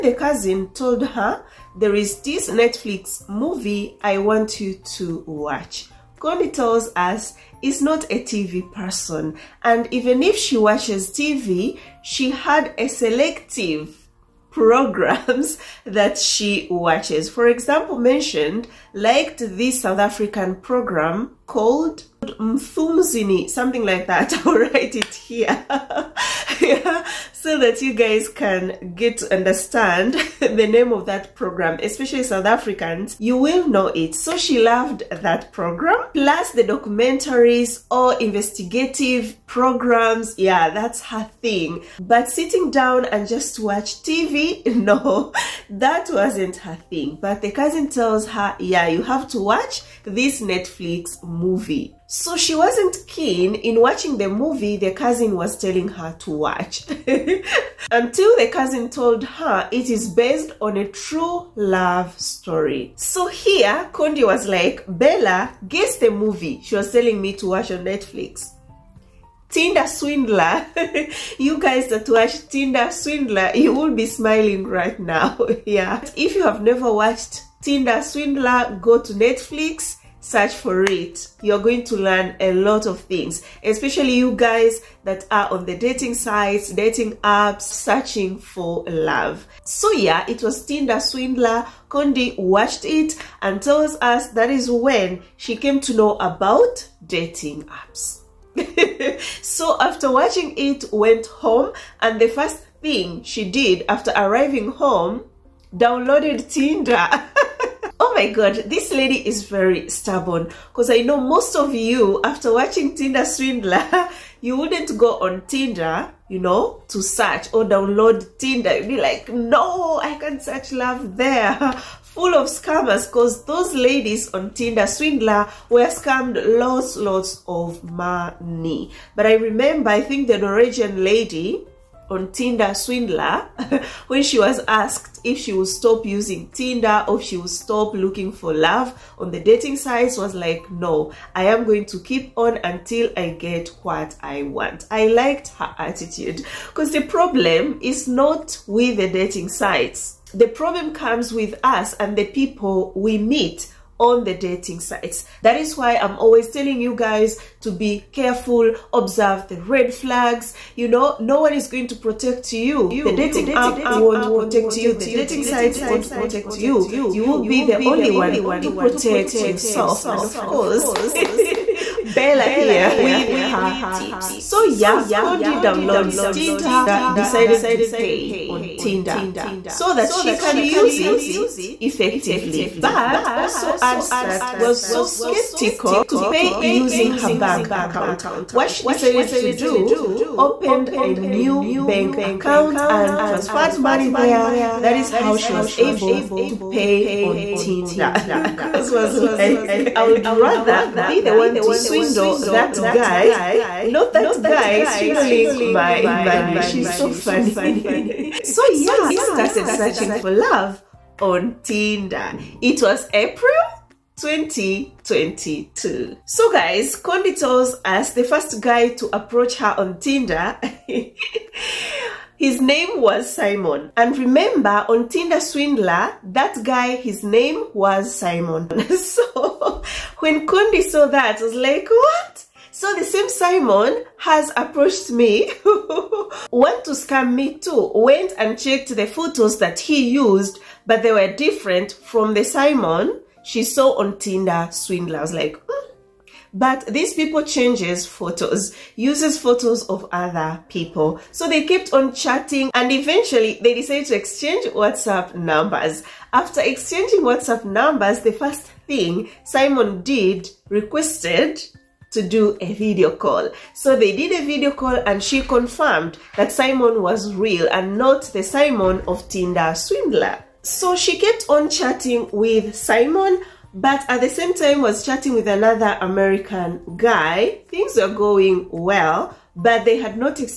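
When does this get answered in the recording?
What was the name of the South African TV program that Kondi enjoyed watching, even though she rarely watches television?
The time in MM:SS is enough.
00:22.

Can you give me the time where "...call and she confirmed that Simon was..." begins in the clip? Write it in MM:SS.
04:24.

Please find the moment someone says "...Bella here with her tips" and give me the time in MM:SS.
02:52.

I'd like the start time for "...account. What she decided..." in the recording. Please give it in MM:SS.
03:07.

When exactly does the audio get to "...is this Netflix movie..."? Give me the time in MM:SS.
00:01.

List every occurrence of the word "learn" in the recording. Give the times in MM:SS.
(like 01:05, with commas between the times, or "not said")
01:21.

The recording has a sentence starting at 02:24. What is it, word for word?
I liked her attitude because the problem is not with the dating sites.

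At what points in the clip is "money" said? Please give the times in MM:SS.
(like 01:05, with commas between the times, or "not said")
02:07, 03:13, 03:26.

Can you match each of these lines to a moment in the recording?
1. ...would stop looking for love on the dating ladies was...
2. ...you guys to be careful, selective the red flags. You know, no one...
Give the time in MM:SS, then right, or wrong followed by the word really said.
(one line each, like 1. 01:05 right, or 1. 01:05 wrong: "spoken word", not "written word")
1. 02:17 wrong: "sites", not "ladies"
2. 02:36 wrong: "observe", not "selective".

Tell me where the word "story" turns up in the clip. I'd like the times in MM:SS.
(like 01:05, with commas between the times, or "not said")
01:02.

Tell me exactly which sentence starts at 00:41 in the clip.
But sitting down and just watch TV, no, that wasn't her thing.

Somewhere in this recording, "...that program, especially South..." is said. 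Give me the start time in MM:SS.
00:31.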